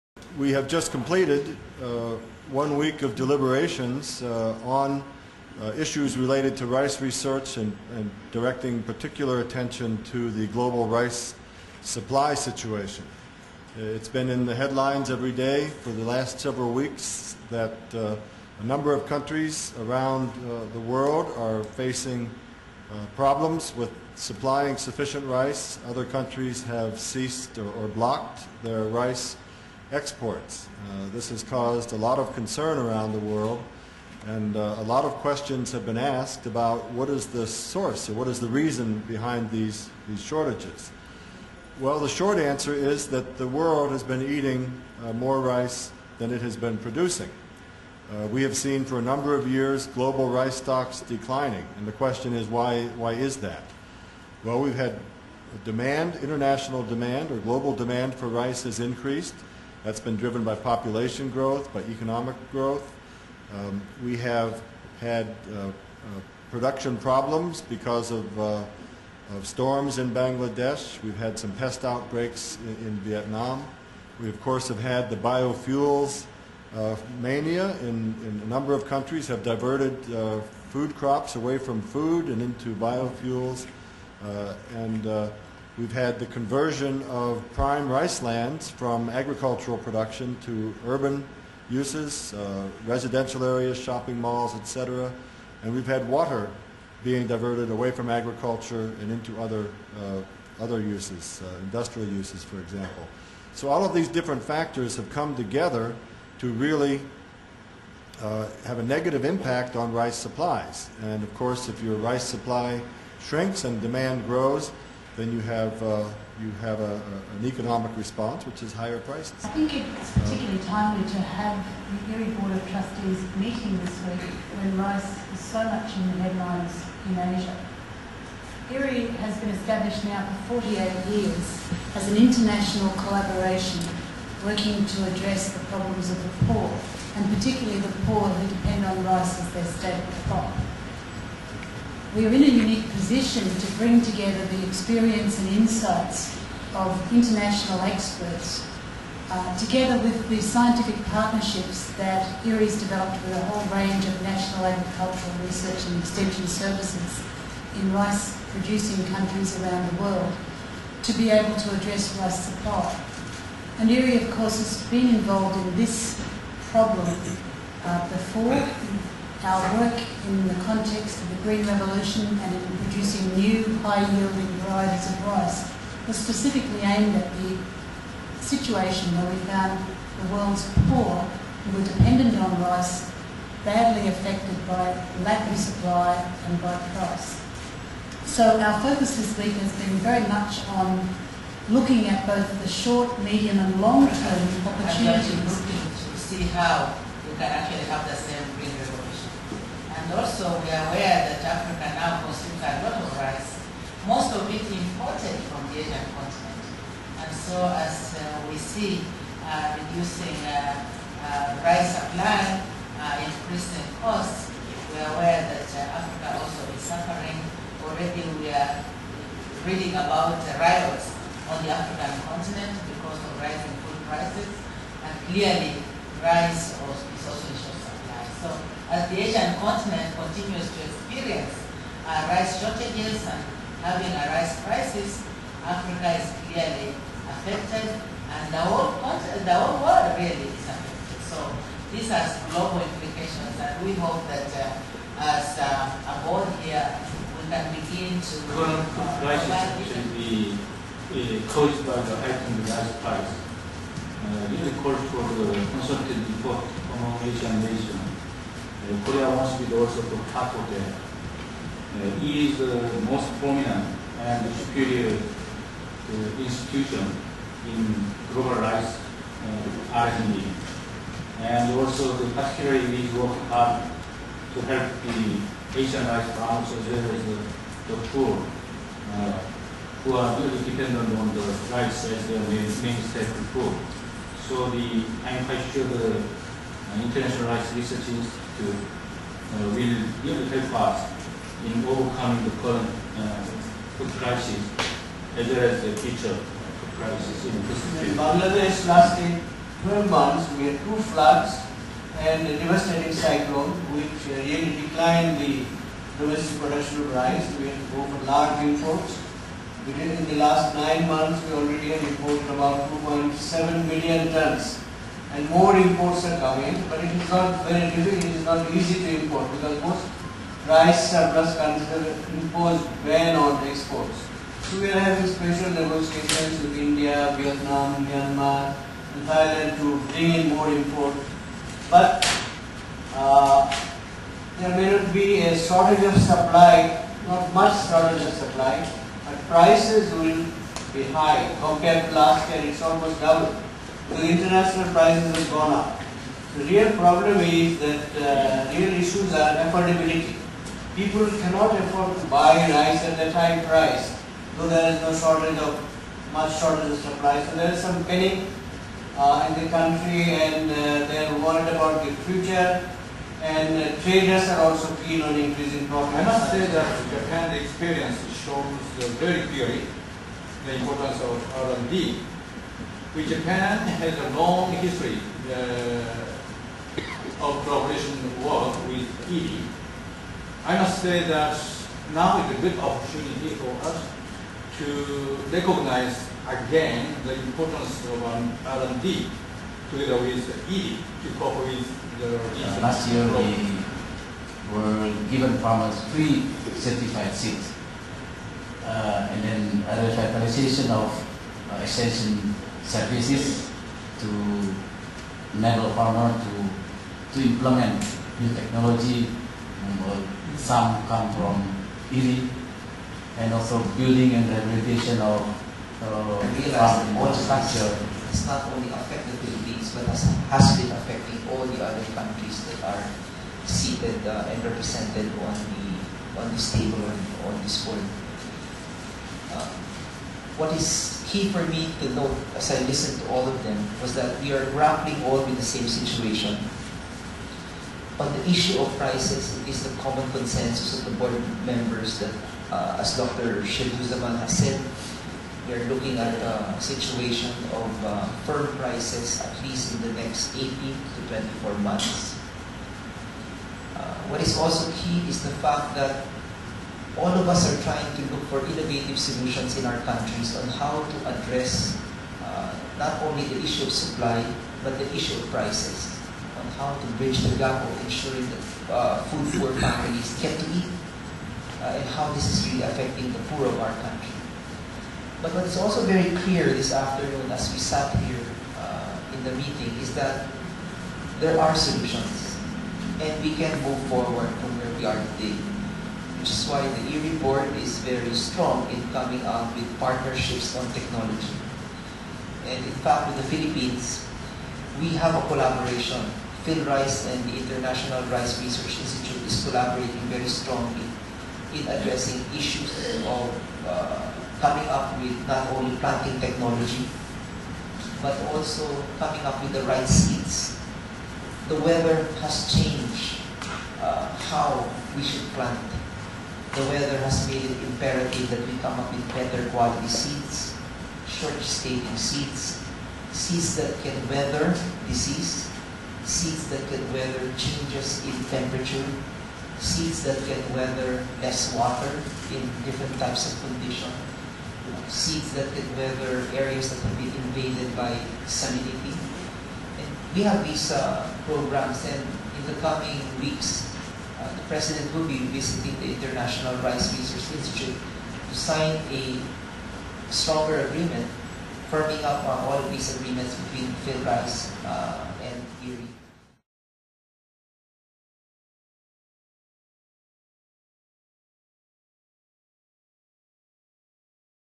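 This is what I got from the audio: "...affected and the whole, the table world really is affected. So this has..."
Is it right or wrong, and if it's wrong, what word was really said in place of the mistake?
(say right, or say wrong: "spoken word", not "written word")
wrong: "whole", not "table".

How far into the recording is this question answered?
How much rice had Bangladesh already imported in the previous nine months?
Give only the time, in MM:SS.
05:12.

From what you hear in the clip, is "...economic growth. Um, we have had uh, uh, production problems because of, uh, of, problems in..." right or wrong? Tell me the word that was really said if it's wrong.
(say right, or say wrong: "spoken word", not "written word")
wrong: "storms", not "problems".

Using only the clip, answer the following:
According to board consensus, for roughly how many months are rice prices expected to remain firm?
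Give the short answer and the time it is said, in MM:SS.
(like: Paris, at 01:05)
18 to 24, at 07:30.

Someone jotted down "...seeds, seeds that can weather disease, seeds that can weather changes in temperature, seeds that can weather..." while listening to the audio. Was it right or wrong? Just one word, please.
right.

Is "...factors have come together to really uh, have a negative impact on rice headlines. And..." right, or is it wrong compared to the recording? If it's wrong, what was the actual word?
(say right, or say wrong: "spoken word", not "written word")
wrong: "supplies", not "headlines".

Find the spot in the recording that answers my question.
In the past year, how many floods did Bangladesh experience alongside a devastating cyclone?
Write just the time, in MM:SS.
05:00.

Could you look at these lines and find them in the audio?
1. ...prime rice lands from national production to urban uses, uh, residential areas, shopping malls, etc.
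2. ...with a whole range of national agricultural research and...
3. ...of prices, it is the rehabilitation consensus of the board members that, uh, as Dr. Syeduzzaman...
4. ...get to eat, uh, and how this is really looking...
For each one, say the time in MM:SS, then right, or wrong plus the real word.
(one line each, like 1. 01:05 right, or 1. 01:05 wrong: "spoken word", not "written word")
1. 01:27 wrong: "agricultural", not "national"
2. 02:33 right
3. 07:18 wrong: "common", not "rehabilitation"
4. 07:50 wrong: "affecting", not "looking".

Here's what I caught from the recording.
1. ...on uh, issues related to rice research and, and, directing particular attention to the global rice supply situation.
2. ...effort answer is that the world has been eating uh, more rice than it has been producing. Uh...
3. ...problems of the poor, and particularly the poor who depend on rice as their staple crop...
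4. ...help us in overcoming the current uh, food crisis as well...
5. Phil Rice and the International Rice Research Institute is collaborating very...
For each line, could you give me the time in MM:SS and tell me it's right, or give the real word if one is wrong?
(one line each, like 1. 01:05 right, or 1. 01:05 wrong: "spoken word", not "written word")
1. 00:04 right
2. 00:42 wrong: "short", not "effort"
3. 02:15 right
4. 04:50 right
5. 08:16 right.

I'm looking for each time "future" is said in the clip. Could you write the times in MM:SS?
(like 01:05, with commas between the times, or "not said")
04:56, 06:02.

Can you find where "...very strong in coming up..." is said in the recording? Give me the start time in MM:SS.
08:08.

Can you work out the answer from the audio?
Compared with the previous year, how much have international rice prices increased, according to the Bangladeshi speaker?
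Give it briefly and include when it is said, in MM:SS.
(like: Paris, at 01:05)
almost double, at 05:42.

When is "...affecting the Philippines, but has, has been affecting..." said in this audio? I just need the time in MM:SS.
06:58.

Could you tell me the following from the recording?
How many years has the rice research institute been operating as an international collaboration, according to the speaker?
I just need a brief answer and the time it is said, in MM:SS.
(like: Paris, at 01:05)
48, at 02:10.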